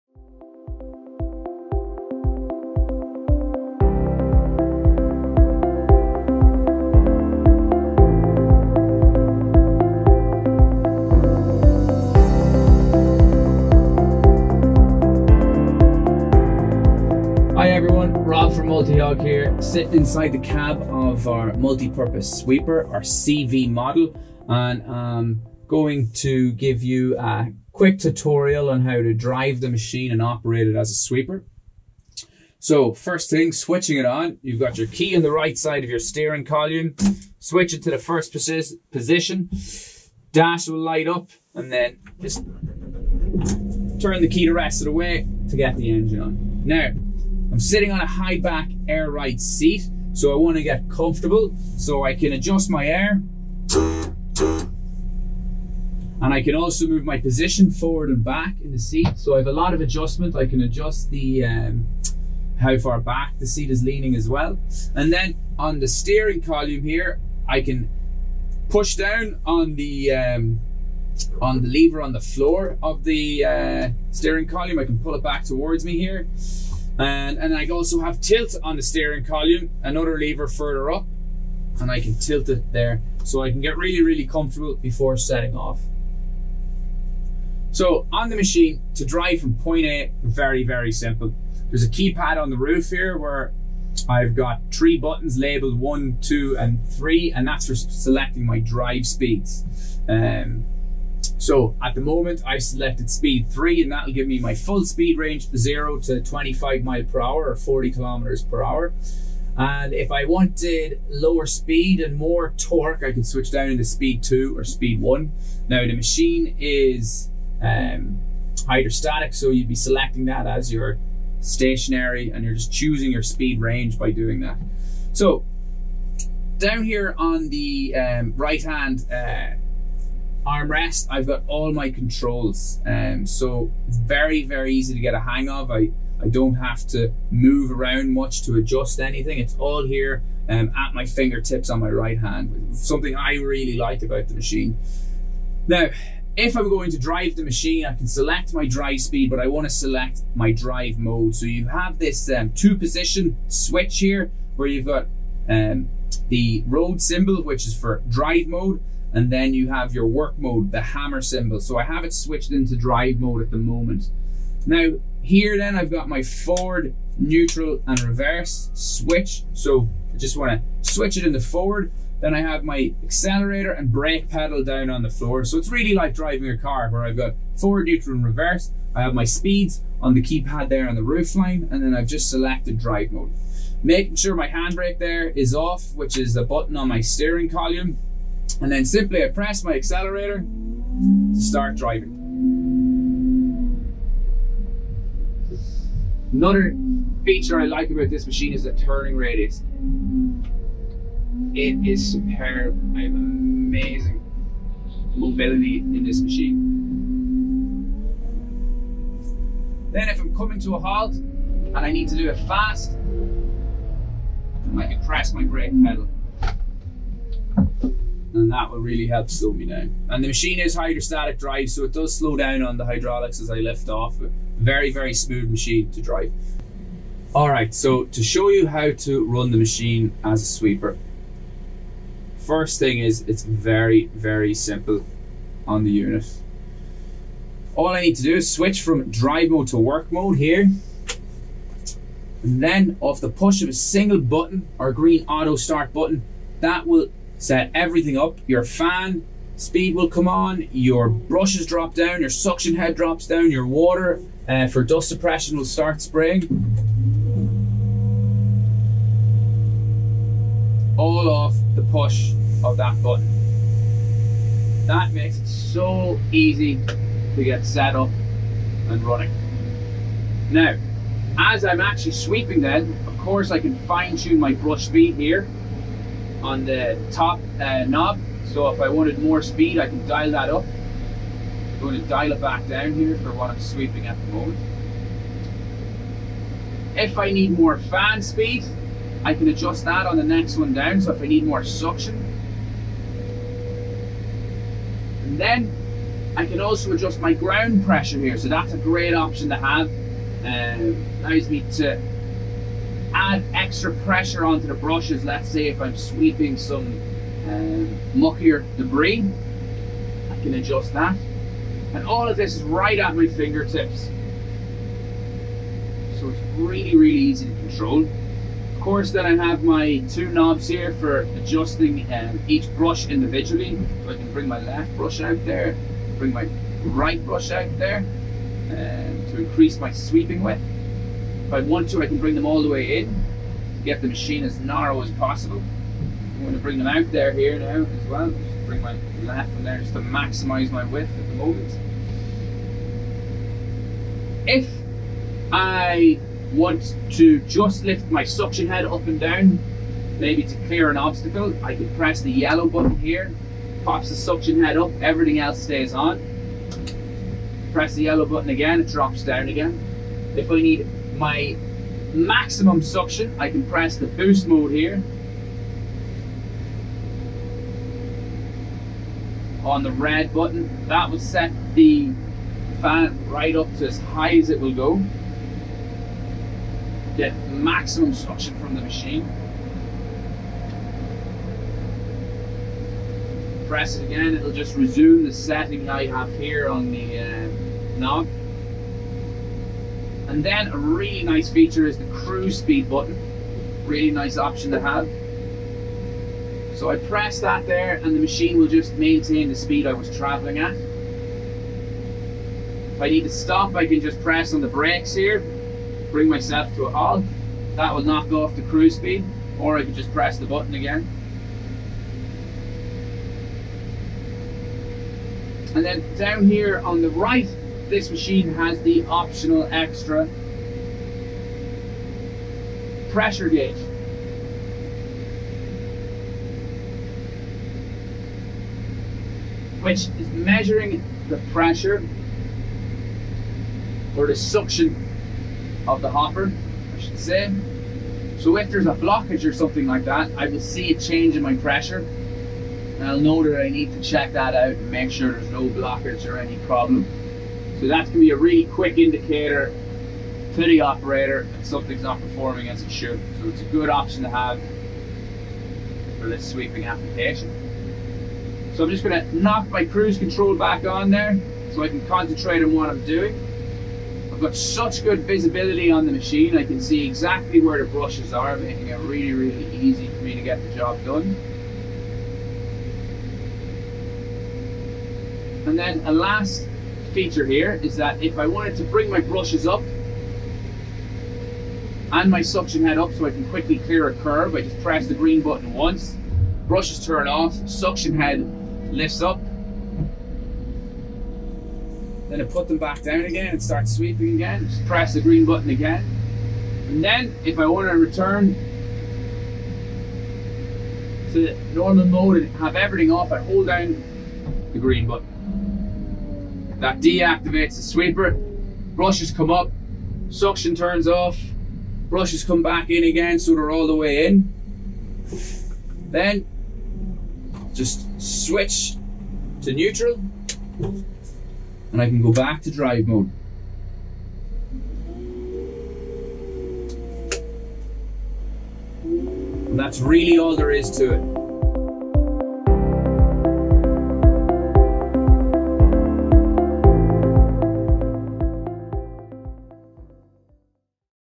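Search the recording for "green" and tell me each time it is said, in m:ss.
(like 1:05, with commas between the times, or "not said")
4:04, 8:05, 8:15, 8:24.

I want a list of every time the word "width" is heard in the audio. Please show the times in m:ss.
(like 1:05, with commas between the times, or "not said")
5:30, 5:40.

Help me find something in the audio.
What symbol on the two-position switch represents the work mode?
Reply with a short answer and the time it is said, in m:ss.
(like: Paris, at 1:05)
Hammer, at 2:40.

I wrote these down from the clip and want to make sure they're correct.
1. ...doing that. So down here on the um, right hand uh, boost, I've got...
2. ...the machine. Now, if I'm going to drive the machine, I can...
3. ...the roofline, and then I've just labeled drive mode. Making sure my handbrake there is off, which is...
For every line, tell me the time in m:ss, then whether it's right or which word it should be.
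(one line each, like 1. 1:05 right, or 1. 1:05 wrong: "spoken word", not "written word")
1. 2:04 wrong: "armrest", not "boost"
2. 2:24 right
3. 3:00 wrong: "selected", not "labeled".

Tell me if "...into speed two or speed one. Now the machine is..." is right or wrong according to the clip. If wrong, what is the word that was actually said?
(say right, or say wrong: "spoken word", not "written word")
right.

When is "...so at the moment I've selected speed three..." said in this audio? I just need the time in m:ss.
1:41.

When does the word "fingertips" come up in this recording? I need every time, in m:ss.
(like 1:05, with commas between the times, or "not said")
2:21, 5:13.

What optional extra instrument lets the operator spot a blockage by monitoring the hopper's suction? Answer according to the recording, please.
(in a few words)
Pressure gauge.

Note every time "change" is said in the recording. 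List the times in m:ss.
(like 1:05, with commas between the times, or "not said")
7:20.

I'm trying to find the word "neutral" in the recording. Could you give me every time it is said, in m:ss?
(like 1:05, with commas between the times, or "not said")
2:47, 2:57, 8:39.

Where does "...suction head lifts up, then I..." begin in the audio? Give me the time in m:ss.
8:07.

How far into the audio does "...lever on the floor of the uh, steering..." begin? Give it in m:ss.
1:11.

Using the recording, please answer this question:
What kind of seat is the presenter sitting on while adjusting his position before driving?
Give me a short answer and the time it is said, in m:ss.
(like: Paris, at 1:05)
High back air ride seat, at 0:48.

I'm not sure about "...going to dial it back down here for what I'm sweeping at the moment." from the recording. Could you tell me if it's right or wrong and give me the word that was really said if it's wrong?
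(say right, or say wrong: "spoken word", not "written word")
right.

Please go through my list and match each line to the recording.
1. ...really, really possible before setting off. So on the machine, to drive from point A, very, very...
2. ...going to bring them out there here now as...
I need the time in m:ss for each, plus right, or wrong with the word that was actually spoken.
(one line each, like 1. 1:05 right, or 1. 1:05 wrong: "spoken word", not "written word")
1. 1:23 wrong: "comfortable", not "possible"
2. 5:36 right.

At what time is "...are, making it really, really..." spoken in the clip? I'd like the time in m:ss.
7:48.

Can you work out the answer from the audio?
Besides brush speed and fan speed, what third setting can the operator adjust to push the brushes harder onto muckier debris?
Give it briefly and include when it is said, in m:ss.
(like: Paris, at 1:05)
Ground pressure, at 4:57.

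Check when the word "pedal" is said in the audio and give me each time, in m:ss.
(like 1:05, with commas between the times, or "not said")
2:54, 3:35.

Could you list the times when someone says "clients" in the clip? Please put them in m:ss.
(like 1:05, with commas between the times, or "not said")
not said.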